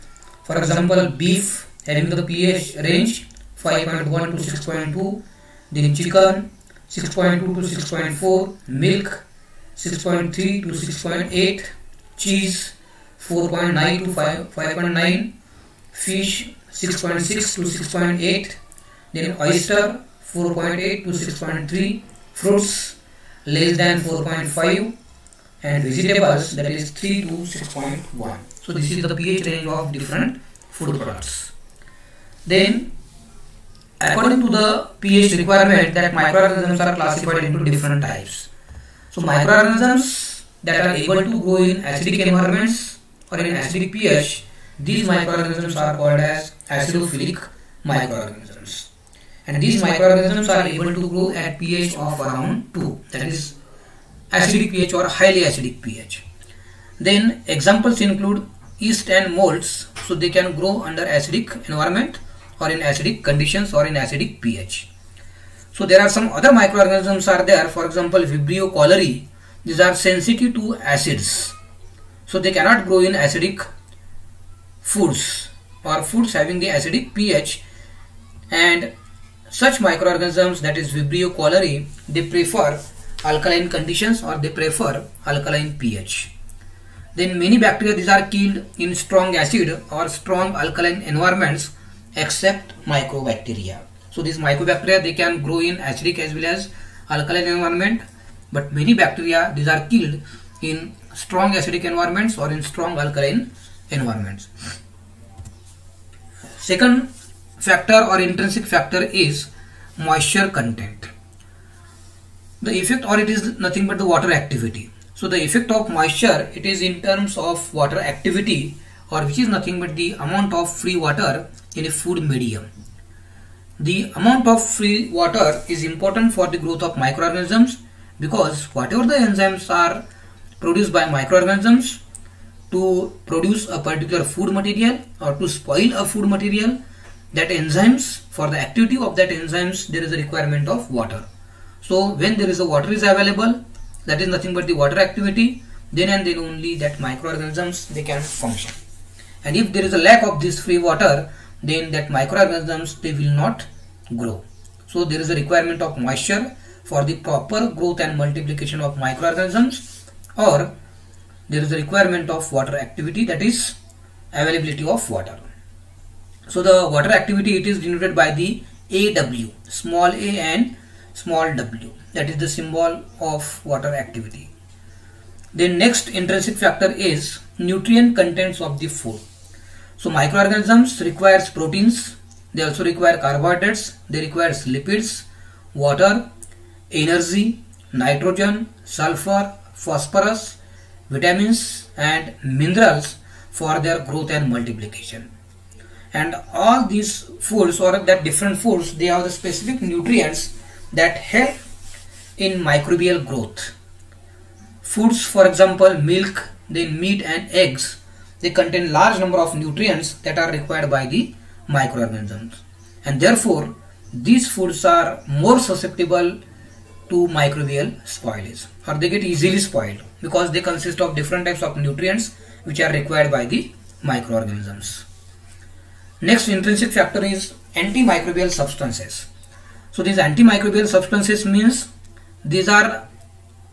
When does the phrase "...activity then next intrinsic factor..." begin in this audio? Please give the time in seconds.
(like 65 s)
173 s.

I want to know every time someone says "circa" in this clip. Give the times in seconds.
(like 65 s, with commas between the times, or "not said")
not said.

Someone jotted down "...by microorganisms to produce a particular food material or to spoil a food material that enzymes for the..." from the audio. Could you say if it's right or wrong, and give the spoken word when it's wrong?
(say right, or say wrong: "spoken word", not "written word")
right.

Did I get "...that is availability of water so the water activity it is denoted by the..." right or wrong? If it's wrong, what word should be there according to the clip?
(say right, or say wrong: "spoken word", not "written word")
right.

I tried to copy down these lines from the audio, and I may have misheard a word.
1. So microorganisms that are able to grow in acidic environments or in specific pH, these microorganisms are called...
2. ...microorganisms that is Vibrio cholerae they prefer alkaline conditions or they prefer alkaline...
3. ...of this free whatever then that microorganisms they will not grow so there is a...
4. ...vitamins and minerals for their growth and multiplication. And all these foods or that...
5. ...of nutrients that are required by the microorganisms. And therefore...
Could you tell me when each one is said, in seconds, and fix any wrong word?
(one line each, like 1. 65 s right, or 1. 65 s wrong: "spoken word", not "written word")
1. 39 s wrong: "acidic", not "specific"
2. 79 s right
3. 150 s wrong: "water", not "whatever"
4. 191 s right
5. 209 s right.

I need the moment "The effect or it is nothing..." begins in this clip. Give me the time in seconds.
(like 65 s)
112 s.